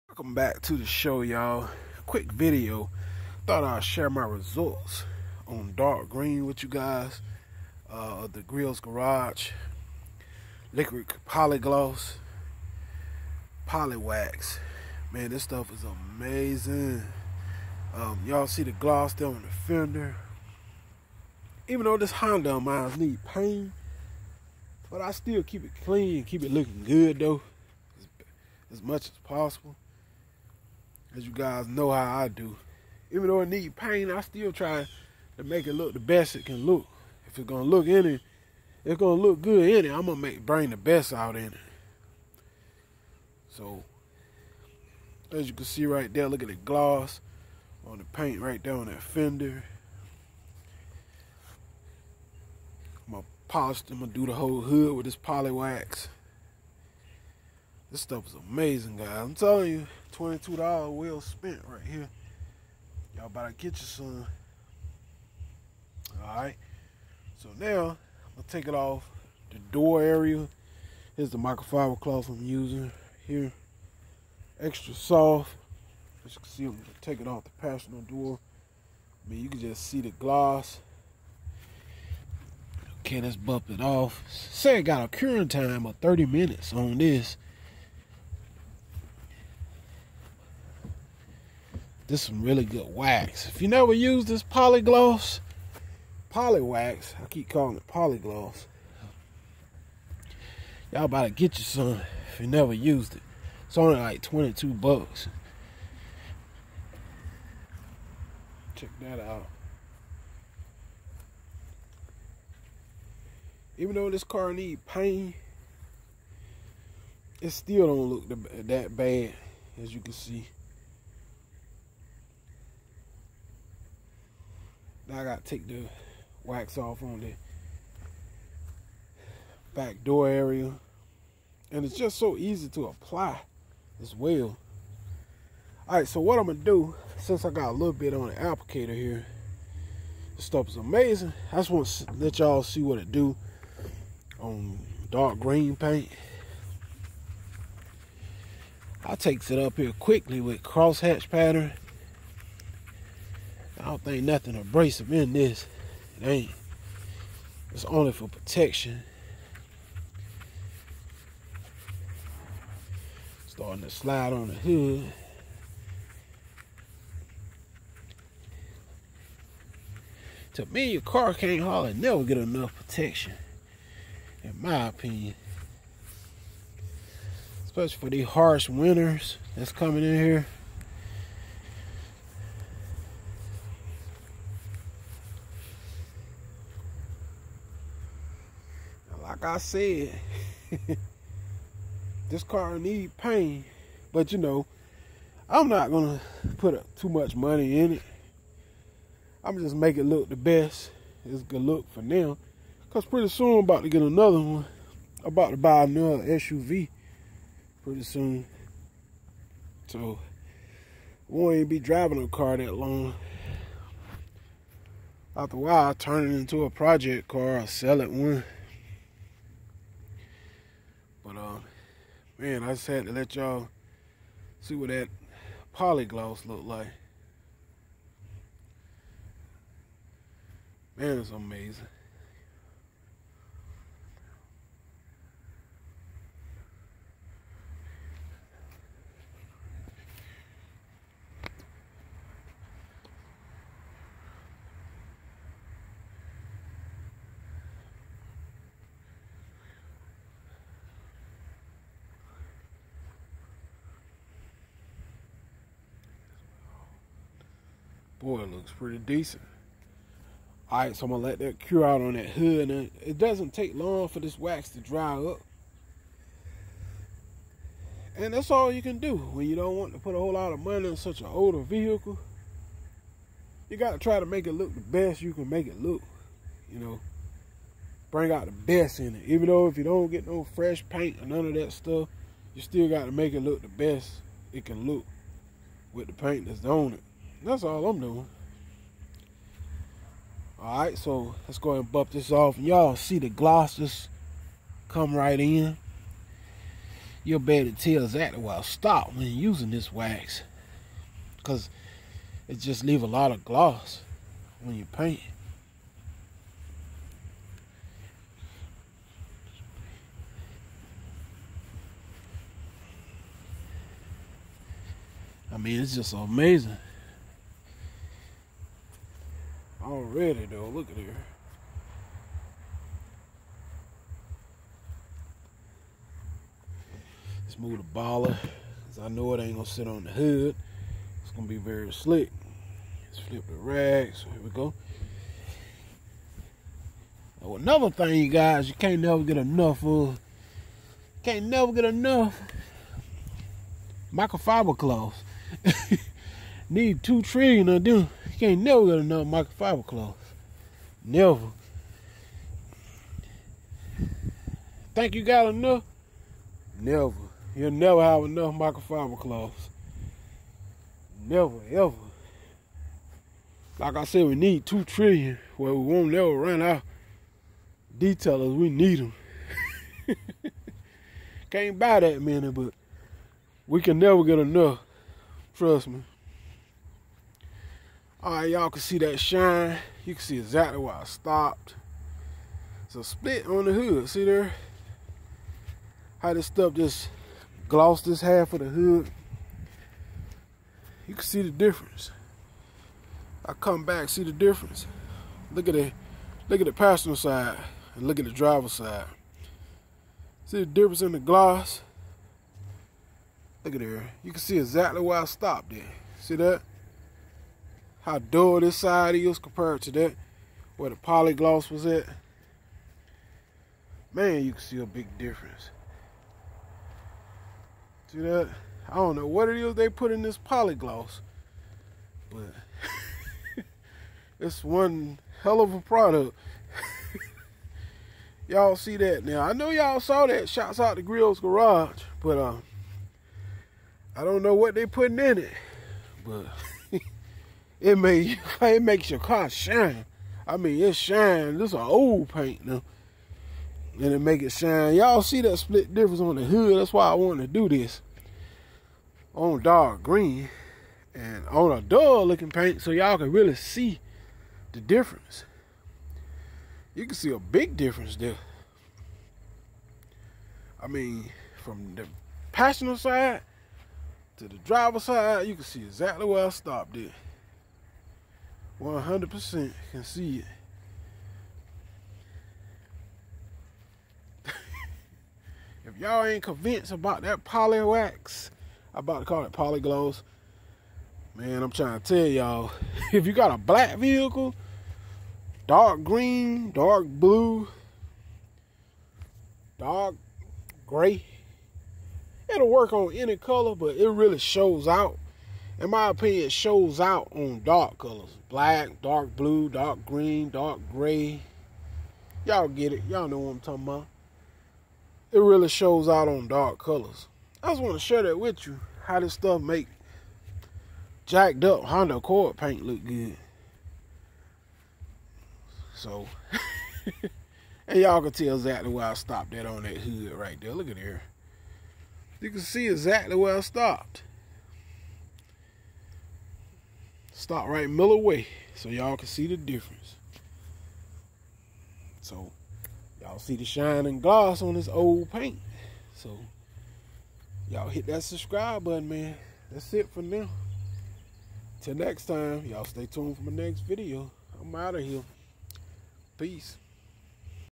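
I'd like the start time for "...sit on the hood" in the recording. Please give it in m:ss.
5:29.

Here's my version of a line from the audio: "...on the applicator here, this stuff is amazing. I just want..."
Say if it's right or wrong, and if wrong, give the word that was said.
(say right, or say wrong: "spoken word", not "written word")
right.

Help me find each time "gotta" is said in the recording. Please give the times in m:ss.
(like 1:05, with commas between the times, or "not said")
2:05, 4:33, 4:42.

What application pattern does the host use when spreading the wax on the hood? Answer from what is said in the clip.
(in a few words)
Crosshatch.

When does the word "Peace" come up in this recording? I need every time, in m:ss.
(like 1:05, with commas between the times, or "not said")
9:06.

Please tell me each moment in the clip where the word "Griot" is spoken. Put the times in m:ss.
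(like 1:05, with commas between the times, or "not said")
0:08, 7:11.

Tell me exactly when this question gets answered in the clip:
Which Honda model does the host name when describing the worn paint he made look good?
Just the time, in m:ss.
8:31.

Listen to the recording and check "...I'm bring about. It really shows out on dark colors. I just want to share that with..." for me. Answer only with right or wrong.
wrong.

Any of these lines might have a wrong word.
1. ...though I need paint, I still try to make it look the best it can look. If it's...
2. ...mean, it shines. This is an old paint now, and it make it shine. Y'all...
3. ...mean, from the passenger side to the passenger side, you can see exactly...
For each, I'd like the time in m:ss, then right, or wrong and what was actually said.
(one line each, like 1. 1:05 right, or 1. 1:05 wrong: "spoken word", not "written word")
1. 0:33 right
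2. 7:20 right
3. 7:40 wrong: "driver", not "passenger".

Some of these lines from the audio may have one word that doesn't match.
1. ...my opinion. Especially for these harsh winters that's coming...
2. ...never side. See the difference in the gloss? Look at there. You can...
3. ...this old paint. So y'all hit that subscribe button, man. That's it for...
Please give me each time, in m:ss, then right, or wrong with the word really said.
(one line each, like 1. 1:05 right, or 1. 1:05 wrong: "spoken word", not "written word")
1. 2:54 right
2. 6:38 wrong: "driver", not "never"
3. 8:54 right.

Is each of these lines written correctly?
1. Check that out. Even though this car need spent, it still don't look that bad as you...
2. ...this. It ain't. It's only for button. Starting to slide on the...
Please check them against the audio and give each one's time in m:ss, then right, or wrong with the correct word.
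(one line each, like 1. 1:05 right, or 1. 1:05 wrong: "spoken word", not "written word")
1. 1:48 wrong: "paint", not "spent"
2. 2:35 wrong: "protection", not "button".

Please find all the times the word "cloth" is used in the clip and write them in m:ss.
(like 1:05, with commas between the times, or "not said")
1:11, 5:44, 5:49, 5:59.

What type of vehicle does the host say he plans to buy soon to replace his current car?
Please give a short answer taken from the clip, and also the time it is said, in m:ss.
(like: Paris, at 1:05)
SUV, at 3:26.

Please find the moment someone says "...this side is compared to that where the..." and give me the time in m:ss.
6:48.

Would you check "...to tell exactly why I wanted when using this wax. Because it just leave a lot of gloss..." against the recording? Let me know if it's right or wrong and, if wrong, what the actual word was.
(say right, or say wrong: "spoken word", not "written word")
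wrong: "stopped", not "wanted".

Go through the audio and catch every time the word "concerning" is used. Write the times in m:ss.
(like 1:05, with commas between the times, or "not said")
not said.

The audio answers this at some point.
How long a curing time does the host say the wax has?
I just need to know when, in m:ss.
1:25.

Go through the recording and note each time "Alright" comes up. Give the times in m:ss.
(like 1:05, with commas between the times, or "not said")
1:06, 2:15, 4:50.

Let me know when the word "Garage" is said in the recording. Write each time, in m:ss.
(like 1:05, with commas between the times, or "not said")
0:08, 7:11.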